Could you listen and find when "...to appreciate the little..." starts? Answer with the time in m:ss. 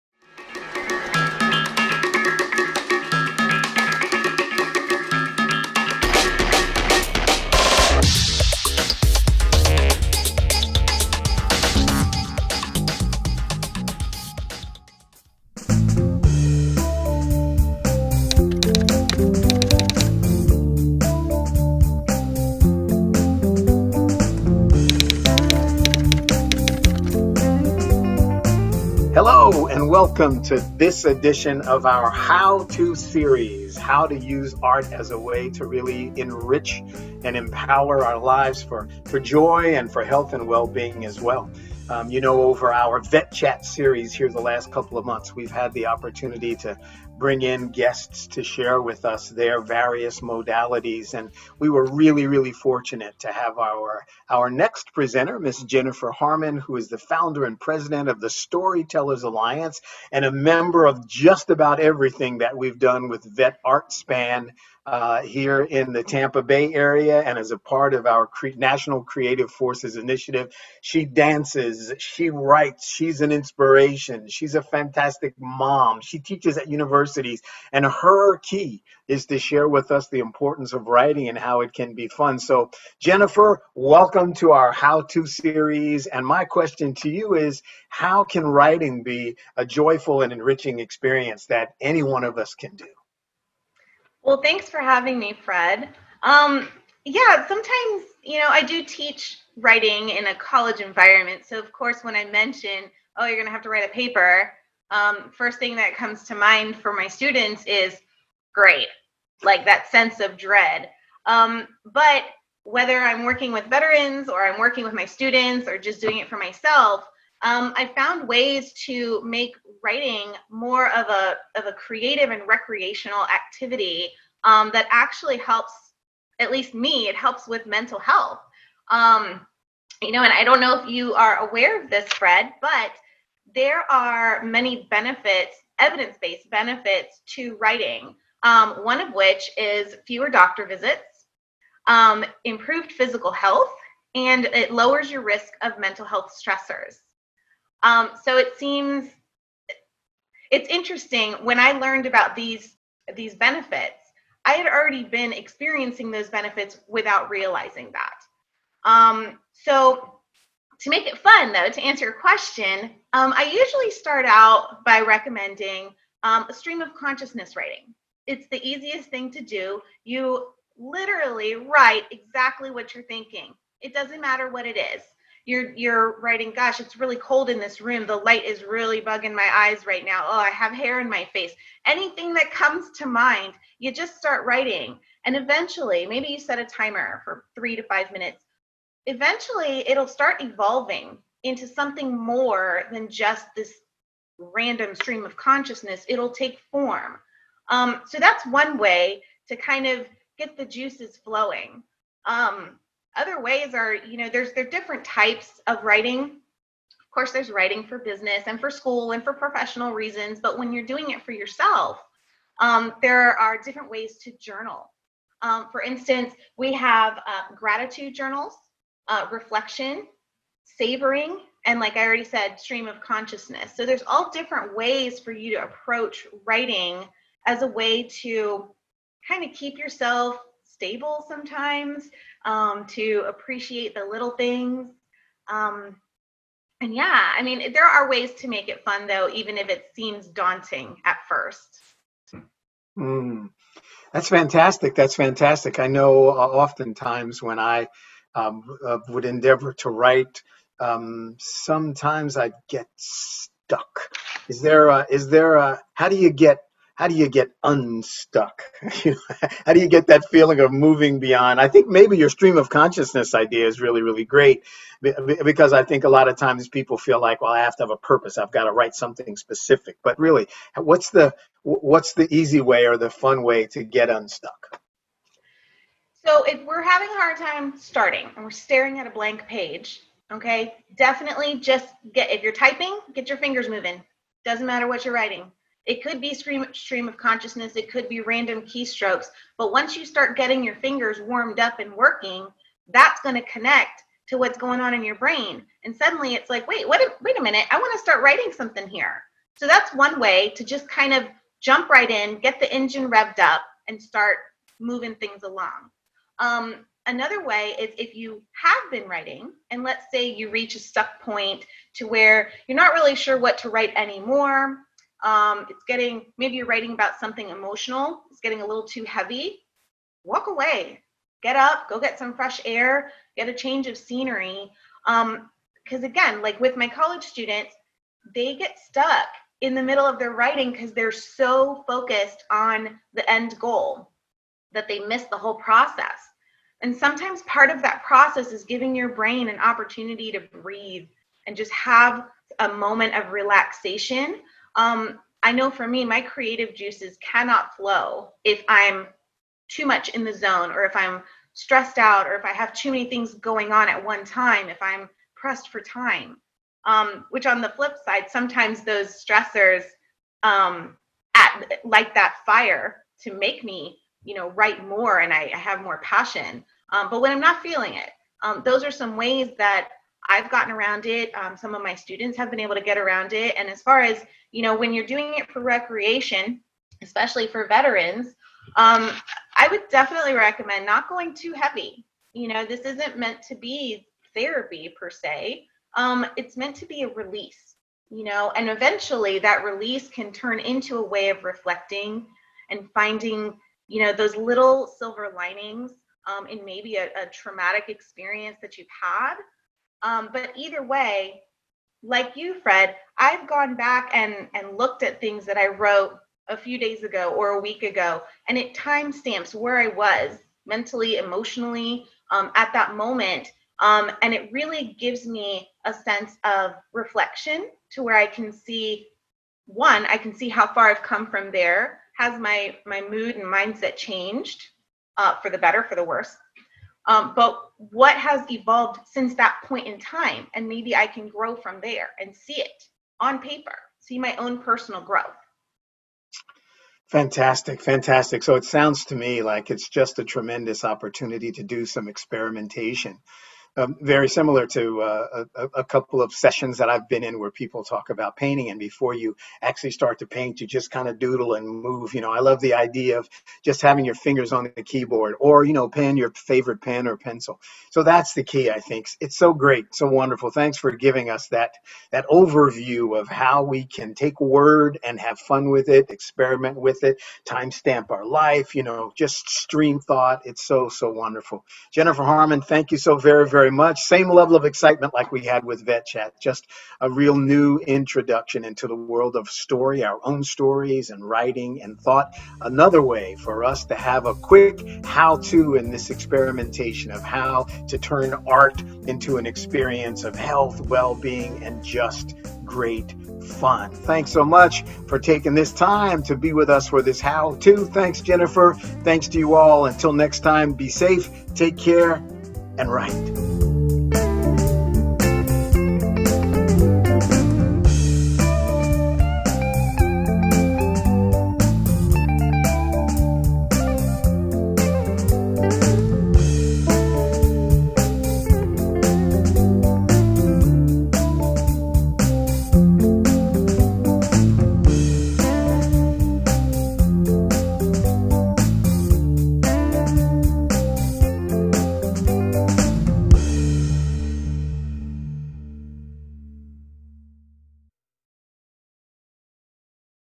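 3:52.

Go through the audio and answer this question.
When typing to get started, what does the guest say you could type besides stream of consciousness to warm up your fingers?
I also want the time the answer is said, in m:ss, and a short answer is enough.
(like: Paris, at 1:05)
Random keystrokes, at 4:48.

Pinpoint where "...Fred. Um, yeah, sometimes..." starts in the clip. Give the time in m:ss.
1:35.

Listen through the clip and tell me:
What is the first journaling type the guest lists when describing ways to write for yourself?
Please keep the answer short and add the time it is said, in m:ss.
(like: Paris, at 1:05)
Gratitude journals, at 3:37.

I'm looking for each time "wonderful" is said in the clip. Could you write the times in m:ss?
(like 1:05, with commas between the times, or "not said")
7:40, 7:51.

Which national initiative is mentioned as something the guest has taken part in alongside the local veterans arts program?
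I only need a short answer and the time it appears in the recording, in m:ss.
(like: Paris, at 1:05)
National Creative Forces Initiative, at 1:08.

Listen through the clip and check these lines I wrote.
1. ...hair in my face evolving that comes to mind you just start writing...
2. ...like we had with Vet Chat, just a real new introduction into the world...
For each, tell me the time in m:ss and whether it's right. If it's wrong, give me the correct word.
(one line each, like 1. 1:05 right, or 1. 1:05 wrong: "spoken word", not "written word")
1. 3:00 wrong: "anything", not "evolving"
2. 7:55 right.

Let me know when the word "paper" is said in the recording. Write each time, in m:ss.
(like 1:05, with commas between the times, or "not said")
1:43, 7:13.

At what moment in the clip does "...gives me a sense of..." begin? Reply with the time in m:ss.
6:54.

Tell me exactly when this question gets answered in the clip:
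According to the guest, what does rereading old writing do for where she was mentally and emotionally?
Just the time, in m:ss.
6:48.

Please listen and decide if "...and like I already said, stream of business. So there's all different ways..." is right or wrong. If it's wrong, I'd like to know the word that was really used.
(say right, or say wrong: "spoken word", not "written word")
wrong: "consciousness", not "business".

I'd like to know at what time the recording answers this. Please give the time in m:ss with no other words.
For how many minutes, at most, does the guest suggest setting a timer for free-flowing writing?
3:07.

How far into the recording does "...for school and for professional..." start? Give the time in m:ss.
3:28.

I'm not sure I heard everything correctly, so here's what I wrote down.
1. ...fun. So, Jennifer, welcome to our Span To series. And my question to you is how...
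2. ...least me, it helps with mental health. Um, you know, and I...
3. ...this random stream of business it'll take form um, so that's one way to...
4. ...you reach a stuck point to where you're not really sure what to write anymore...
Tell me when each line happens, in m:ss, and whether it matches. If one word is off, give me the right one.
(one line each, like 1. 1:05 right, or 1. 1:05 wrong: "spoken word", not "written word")
1. 1:22 wrong: "How", not "Span"
2. 2:06 right
3. 3:13 wrong: "consciousness", not "business"
4. 5:10 right.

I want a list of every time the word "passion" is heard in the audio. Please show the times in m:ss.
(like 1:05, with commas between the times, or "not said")
6:05.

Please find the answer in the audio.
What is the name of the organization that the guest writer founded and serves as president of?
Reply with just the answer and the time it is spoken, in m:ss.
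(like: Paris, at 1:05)
Storytellers Alliance, at 0:58.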